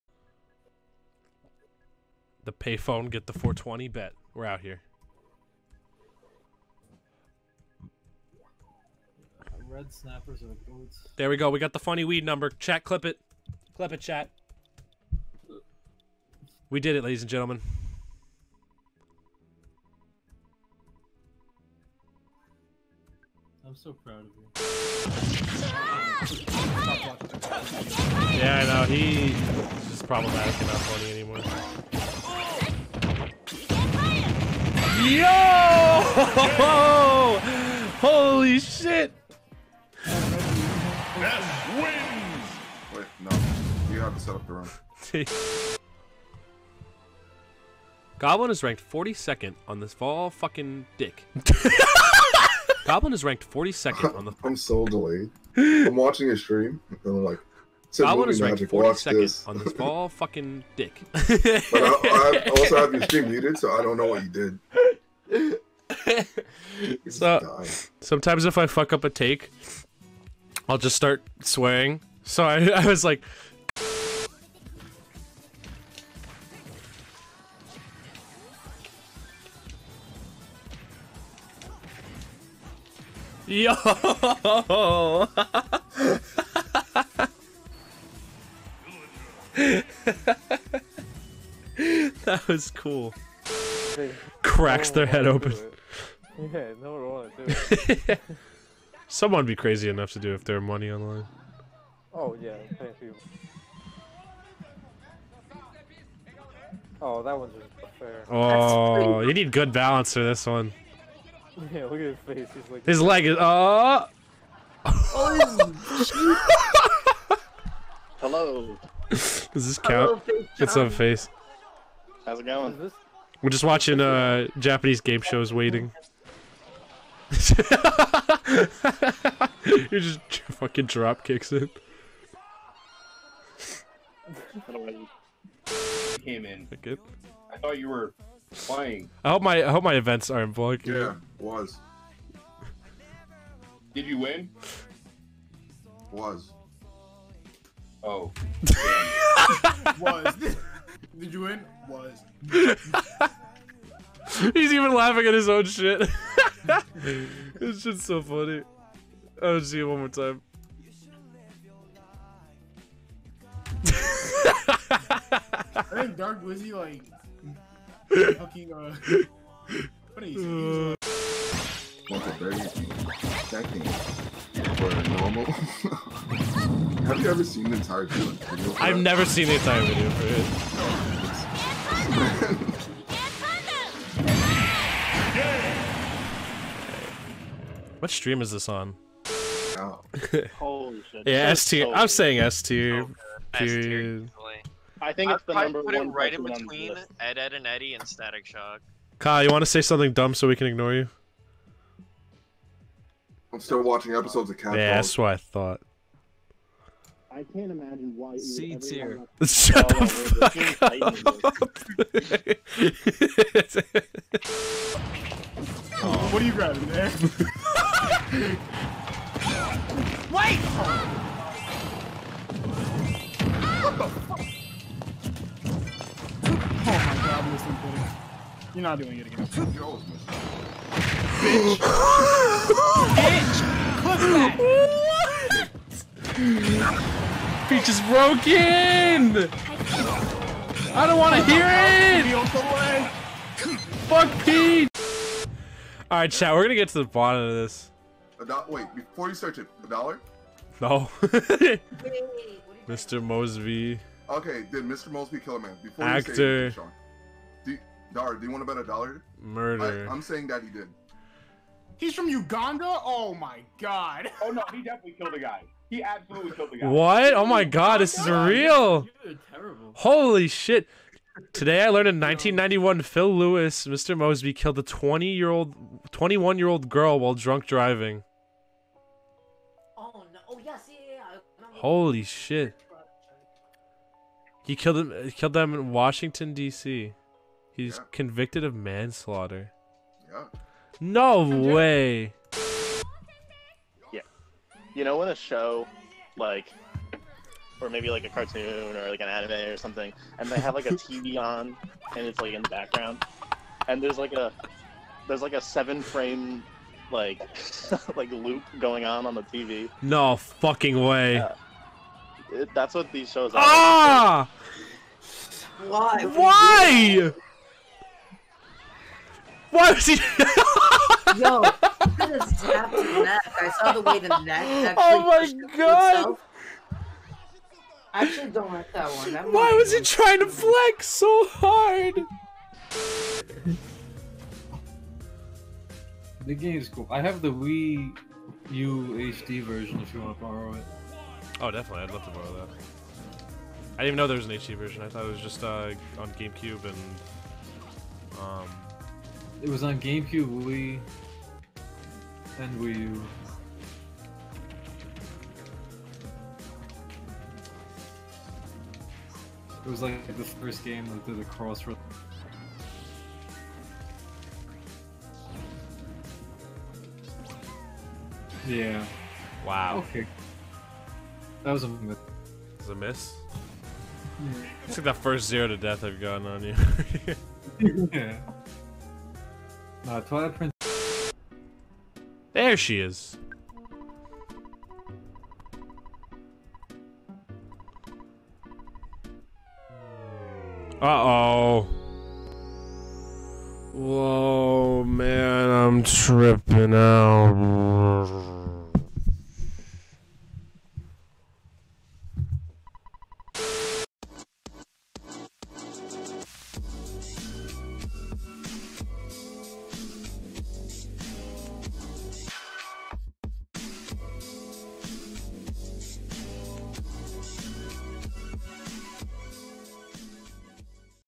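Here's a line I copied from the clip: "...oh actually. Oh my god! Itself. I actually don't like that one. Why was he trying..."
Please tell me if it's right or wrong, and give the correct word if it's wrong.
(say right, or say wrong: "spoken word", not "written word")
right.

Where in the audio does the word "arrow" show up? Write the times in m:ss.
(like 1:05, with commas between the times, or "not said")
not said.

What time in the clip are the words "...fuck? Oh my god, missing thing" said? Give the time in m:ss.
3:44.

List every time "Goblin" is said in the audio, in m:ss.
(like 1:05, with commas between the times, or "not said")
0:48, 0:52, 0:57.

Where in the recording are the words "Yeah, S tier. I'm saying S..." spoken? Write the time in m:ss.
3:11.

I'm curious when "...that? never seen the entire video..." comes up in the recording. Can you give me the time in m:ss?
2:58.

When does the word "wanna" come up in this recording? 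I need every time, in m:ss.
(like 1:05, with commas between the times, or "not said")
1:37.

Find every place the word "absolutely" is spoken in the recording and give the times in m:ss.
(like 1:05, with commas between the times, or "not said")
4:26.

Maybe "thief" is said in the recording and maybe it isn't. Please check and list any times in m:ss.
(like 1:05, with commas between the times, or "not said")
not said.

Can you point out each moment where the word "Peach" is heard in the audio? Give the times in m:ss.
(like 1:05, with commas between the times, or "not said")
3:57, 4:04.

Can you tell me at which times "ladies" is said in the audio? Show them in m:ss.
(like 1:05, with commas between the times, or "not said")
0:17.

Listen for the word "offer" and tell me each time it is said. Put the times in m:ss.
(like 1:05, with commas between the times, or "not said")
not said.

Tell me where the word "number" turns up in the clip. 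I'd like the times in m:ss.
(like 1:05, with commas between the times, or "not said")
0:12, 3:15.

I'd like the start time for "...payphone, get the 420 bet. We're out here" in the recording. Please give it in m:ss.
0:02.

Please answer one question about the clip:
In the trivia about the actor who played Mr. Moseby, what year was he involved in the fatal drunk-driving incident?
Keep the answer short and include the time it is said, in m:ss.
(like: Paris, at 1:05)
1991, at 4:32.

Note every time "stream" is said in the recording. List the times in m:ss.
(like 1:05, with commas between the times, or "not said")
0:56, 1:03, 3:08.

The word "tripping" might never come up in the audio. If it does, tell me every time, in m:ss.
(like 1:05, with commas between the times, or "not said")
6:36.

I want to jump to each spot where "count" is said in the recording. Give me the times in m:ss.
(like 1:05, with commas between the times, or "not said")
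1:59.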